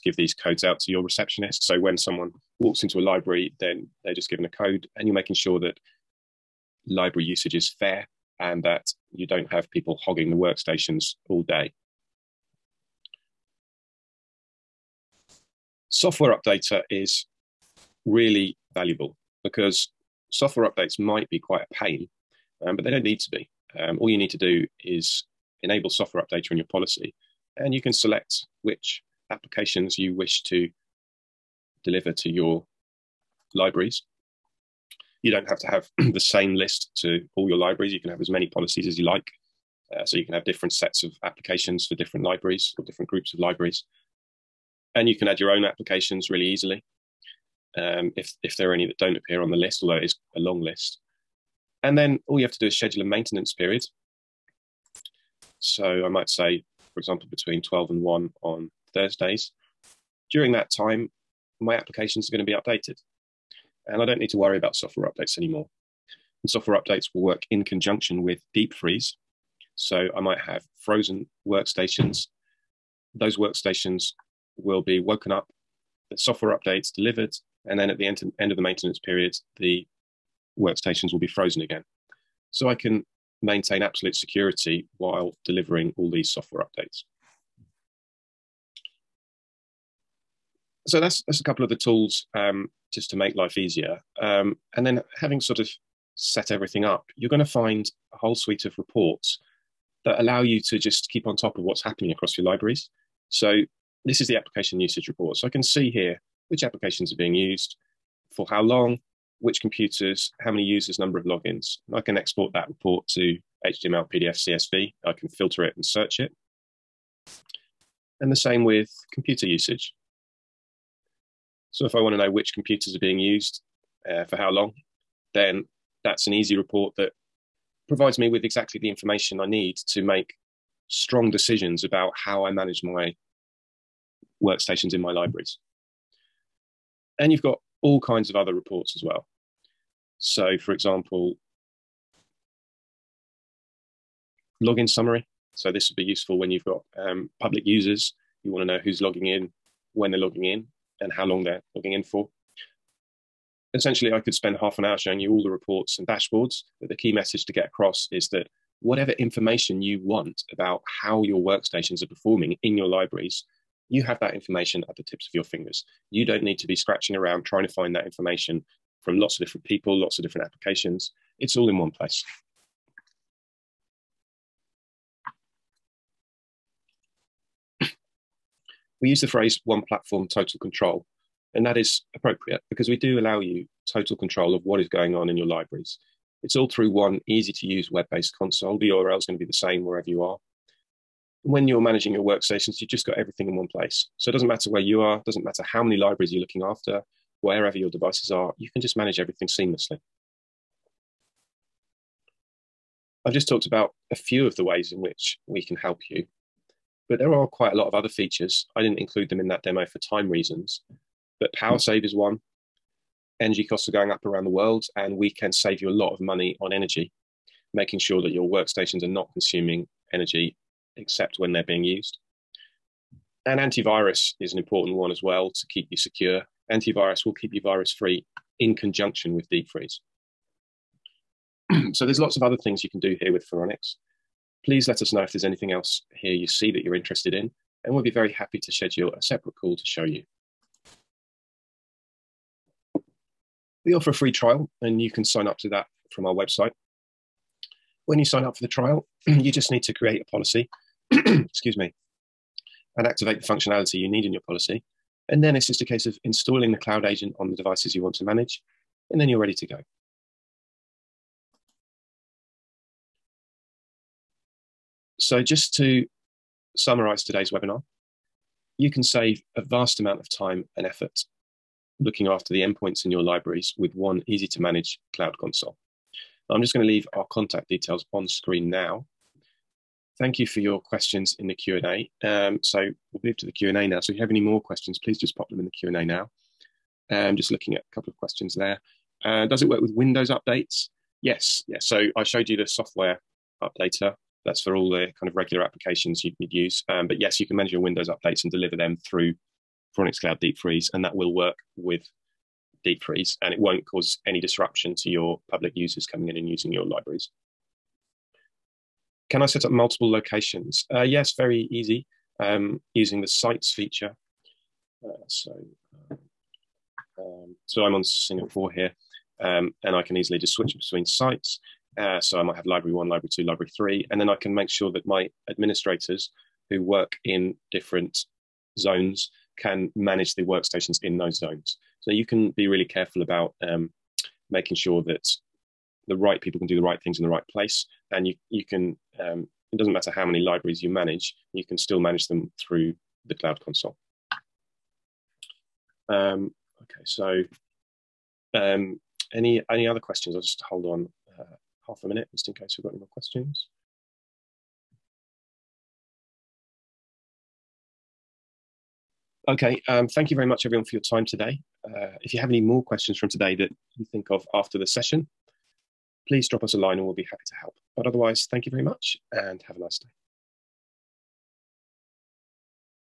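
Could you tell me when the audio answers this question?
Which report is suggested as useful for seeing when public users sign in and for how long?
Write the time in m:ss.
2:24.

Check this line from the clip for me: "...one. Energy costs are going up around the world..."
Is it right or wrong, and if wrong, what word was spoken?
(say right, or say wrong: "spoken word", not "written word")
right.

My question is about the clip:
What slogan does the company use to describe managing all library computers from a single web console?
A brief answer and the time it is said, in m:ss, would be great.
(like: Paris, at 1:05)
One platform total control, at 2:59.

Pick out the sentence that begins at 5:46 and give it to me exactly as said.
Um, okay, so um, any any other questions?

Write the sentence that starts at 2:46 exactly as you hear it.
You don't need to be scratching around trying to find that information from lots of different people, lots of different applications.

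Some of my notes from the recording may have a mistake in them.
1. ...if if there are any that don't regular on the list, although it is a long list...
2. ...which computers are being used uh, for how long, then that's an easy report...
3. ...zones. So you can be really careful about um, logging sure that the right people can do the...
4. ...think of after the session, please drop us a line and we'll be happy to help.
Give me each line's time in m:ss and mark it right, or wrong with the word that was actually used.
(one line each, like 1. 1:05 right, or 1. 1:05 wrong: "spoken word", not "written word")
1. 0:48 wrong: "appear", not "regular"
2. 2:02 right
3. 5:31 wrong: "making", not "logging"
4. 6:04 right.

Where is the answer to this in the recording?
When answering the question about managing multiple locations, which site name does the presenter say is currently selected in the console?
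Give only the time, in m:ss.
5:18.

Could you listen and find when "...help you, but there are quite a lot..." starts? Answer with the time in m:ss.
3:25.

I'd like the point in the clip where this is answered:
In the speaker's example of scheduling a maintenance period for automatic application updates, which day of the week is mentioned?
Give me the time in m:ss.
0:58.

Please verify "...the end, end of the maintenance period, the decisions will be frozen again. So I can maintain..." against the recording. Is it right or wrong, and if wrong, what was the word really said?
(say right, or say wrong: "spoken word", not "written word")
wrong: "workstations", not "decisions".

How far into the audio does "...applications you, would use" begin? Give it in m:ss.
4:55.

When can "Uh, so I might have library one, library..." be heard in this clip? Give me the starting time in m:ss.
5:21.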